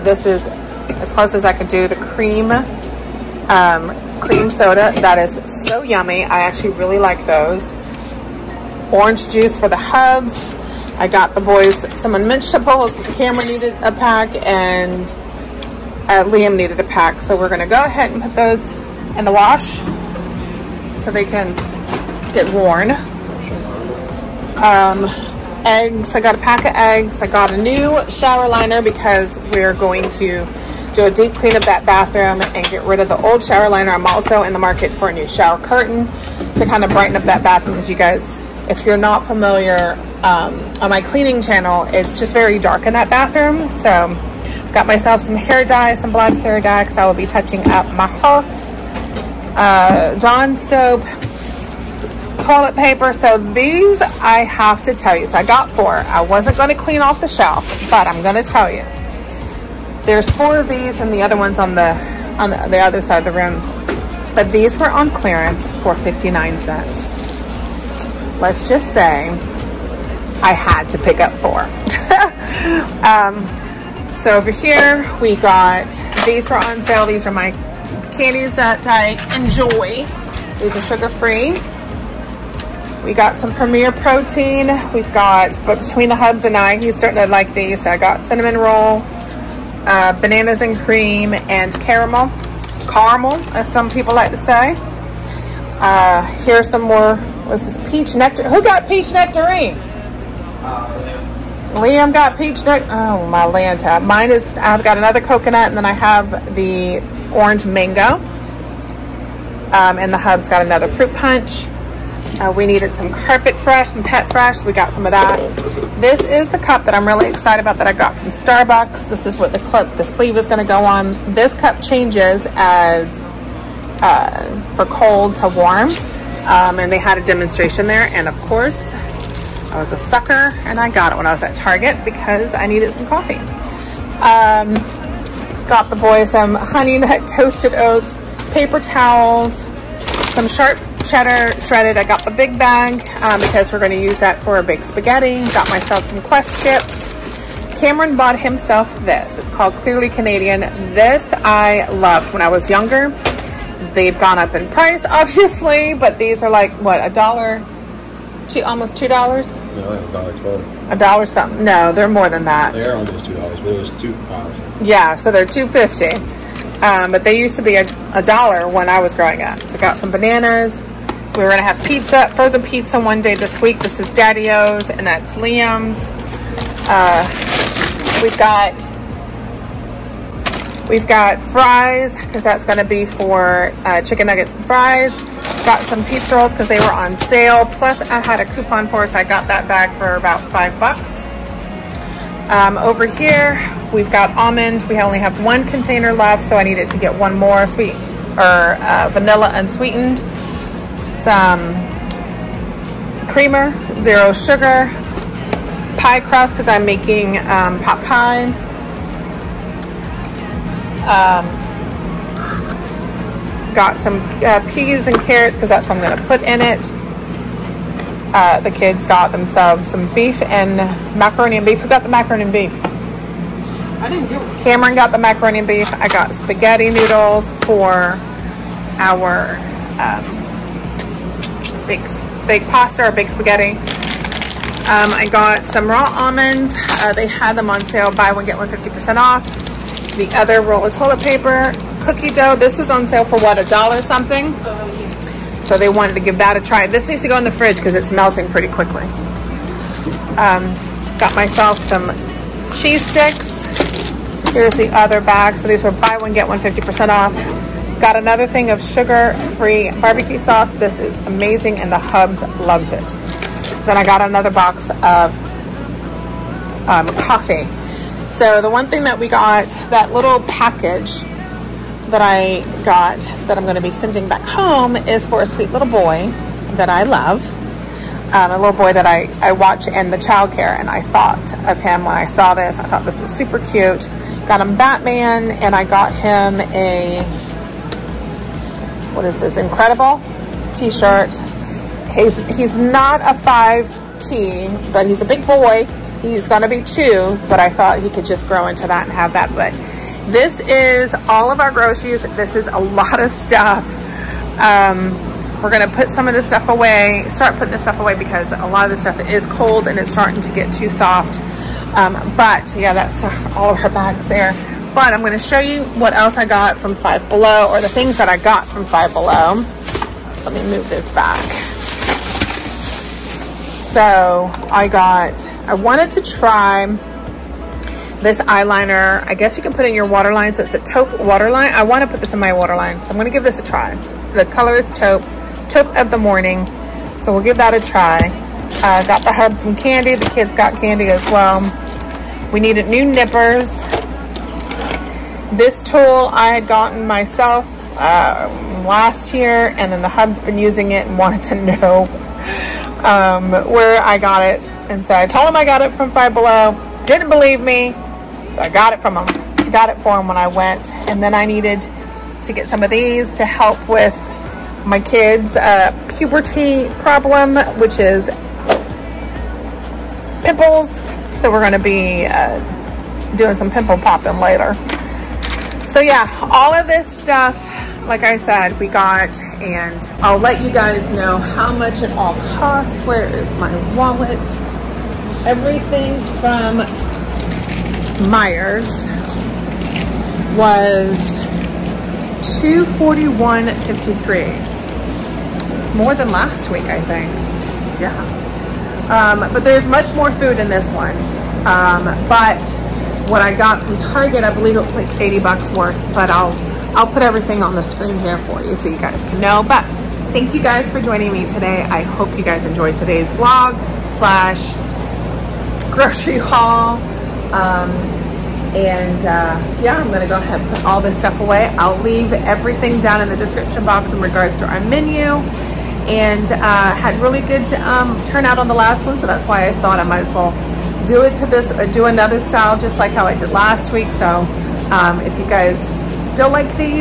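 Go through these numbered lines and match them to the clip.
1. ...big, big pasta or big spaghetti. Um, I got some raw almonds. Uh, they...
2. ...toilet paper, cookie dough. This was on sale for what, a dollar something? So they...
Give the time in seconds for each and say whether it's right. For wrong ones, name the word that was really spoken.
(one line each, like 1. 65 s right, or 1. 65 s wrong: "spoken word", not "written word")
1. 231 s right
2. 240 s right.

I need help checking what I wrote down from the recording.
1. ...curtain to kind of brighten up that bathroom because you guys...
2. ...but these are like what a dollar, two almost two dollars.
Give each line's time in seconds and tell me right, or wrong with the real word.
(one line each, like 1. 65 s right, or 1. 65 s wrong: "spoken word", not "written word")
1. 35 s right
2. 155 s right.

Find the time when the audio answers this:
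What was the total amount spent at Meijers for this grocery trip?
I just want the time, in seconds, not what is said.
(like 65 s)
392 s.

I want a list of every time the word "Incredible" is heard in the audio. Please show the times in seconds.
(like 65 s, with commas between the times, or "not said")
289 s.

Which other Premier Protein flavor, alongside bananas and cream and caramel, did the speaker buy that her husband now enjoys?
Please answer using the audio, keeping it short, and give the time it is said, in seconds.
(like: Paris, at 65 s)
cinnamon roll, at 88 s.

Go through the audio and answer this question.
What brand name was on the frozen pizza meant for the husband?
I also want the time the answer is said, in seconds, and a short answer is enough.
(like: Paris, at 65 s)
Daddy O's, at 174 s.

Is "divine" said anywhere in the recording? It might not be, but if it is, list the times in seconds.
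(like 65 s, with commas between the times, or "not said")
not said.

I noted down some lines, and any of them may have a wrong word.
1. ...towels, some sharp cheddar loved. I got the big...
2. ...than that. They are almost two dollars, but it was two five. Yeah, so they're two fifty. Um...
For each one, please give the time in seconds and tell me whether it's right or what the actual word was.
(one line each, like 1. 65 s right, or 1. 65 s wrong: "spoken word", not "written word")
1. 138 s wrong: "shredded", not "loved"
2. 162 s right.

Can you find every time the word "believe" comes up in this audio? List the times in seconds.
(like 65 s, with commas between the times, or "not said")
357 s, 404 s.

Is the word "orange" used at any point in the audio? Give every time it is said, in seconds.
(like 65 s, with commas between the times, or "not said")
8 s, 107 s.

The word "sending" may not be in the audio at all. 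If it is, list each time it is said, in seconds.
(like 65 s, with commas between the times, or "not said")
273 s.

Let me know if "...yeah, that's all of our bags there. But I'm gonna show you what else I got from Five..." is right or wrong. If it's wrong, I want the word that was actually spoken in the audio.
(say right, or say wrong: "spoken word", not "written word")
right.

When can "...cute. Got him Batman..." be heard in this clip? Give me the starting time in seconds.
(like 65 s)
283 s.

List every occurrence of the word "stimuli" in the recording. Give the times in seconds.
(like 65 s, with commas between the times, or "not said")
not said.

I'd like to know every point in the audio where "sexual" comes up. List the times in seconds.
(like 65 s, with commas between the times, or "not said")
not said.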